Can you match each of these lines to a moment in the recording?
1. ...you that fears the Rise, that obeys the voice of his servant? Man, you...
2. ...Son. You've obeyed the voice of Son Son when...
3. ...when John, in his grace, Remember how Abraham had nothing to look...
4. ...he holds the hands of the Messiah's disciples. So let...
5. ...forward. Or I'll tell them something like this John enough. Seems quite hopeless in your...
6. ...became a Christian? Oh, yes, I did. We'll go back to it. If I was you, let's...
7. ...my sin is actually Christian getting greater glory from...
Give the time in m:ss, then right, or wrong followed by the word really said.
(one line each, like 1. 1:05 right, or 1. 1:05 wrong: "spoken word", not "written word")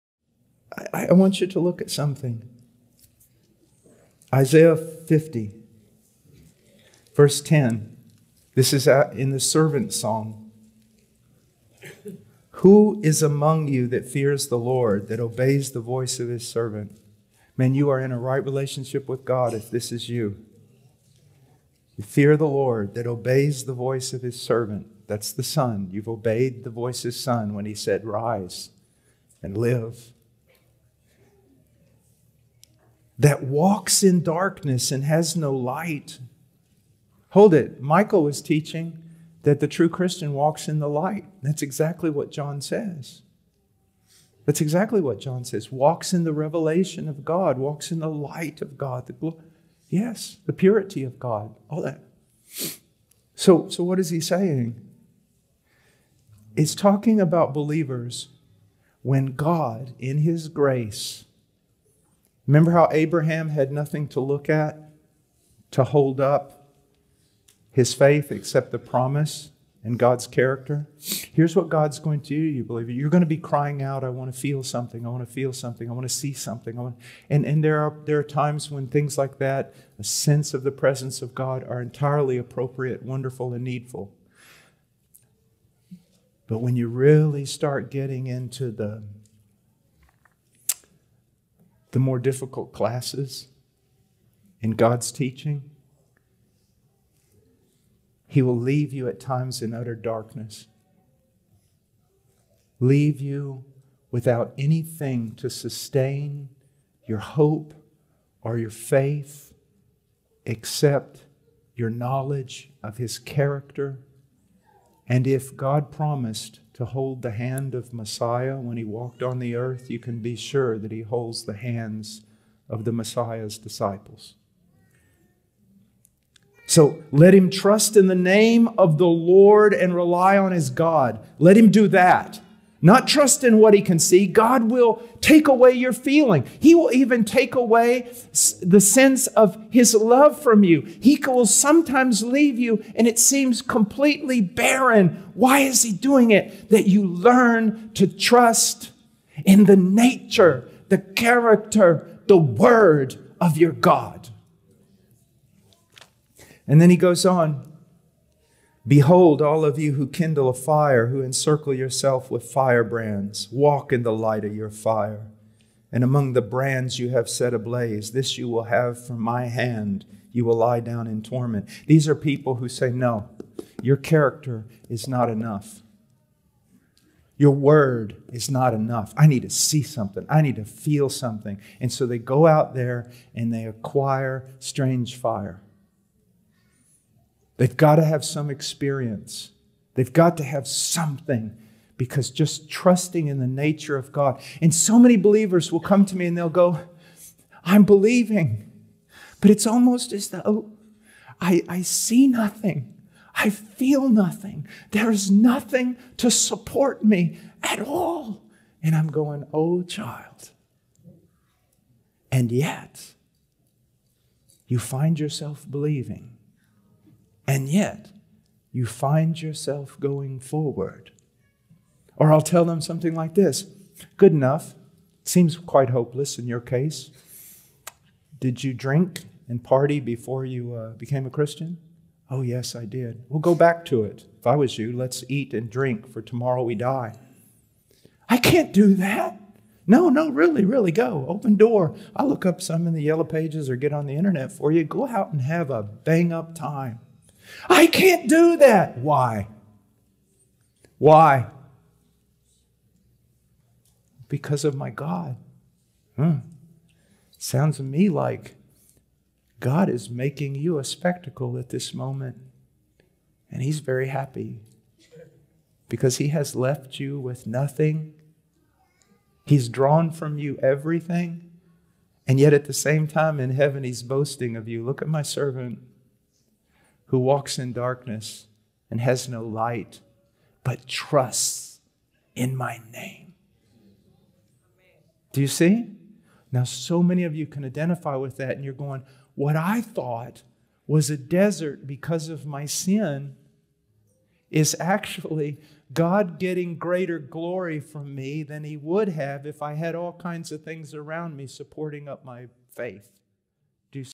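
1. 0:13 wrong: "Lord", not "Rise"
2. 0:25 wrong: "His", not "Son"
3. 0:59 wrong: "God", not "John"
4. 2:00 right
5. 3:40 wrong: "Good", not "John"
6. 3:50 right
7. 4:52 wrong: "God", not "Christian".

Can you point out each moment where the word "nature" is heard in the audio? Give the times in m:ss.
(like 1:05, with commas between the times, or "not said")
2:29, 3:13.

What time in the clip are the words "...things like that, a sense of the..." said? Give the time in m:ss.
1:18.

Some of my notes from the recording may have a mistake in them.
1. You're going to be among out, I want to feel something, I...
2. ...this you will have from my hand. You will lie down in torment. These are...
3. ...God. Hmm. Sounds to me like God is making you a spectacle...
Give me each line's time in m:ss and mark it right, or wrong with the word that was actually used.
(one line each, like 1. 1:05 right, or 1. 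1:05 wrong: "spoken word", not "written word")
1. 1:12 wrong: "crying", not "among"
2. 2:48 right
3. 4:14 right.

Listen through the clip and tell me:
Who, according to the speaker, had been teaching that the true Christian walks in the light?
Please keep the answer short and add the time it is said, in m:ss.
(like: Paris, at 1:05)
Michael, at 0:37.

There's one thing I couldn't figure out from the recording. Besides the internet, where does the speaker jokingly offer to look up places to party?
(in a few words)
the yellow pages.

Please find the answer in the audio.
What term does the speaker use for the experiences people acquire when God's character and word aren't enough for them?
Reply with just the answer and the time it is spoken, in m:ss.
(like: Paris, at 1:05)
strange fire, at 3:04.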